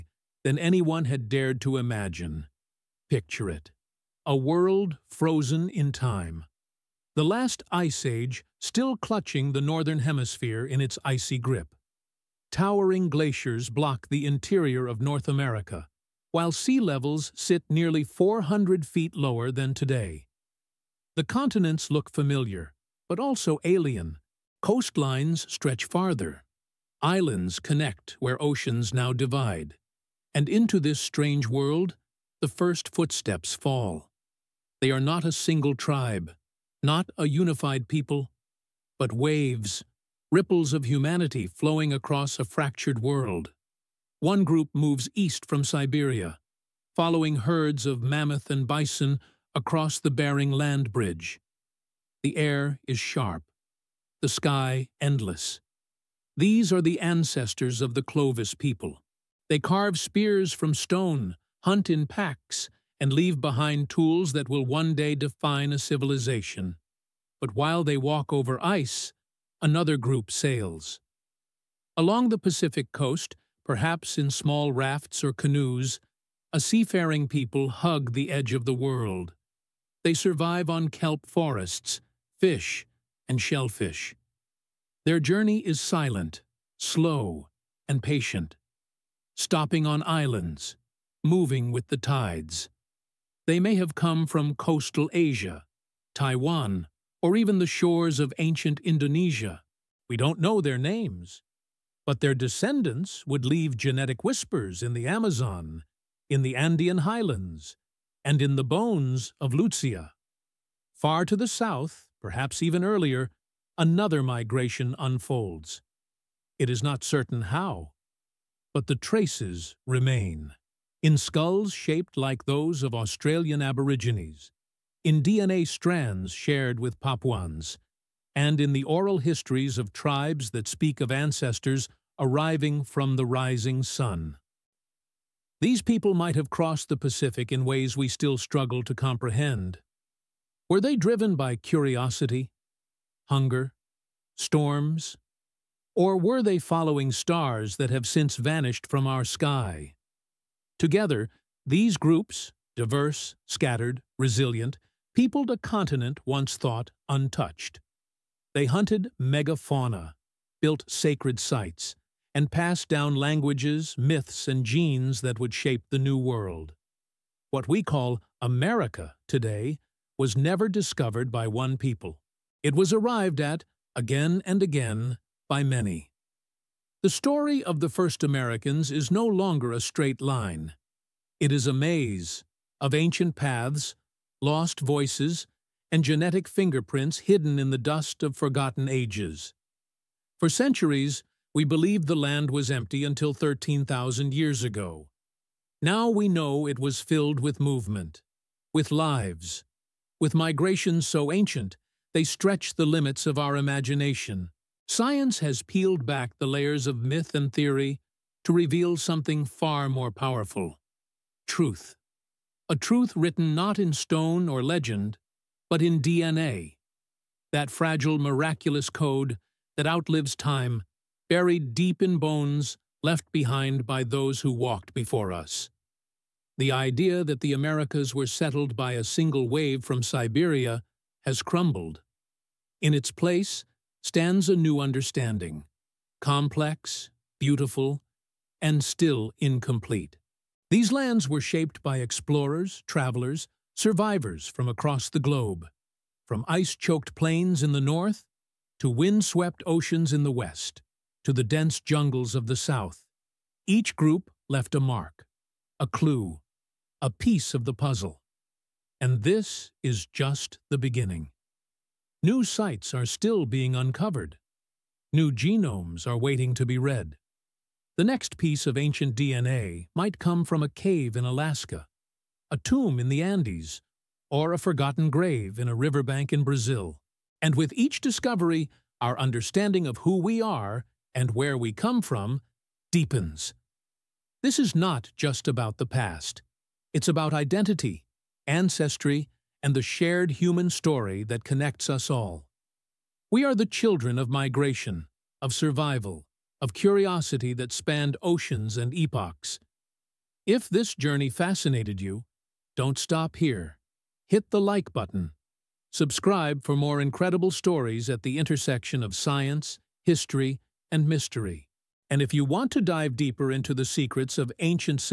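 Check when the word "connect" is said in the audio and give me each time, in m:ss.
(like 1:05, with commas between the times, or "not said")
0:27, 4:51.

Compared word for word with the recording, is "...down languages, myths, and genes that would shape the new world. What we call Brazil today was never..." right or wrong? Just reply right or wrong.
wrong.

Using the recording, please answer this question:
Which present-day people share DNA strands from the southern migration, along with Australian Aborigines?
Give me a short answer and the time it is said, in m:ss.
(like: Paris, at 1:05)
Papuans, at 2:06.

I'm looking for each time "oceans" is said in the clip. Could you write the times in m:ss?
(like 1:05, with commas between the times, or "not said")
0:28, 4:09, 4:58.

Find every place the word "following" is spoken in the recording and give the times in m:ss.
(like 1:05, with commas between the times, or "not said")
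0:46, 2:26.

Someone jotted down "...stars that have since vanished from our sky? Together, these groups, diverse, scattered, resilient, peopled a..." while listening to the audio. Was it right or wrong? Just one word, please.
right.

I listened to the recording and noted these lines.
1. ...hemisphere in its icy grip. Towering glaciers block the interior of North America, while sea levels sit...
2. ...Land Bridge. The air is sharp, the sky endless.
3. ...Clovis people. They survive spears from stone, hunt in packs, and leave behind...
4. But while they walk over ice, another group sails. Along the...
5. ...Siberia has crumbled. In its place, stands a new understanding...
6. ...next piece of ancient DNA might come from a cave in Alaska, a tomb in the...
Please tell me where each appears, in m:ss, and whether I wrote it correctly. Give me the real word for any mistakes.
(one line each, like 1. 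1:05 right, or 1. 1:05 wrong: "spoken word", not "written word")
1. 0:10 right
2. 0:50 right
3. 0:58 wrong: "carve", not "survive"
4. 1:07 right
5. 3:50 right
6. 4:28 right.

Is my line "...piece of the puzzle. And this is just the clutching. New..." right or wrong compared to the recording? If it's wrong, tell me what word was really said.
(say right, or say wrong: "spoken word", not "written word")
wrong: "beginning", not "clutching".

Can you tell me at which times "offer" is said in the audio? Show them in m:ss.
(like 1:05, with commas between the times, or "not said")
not said.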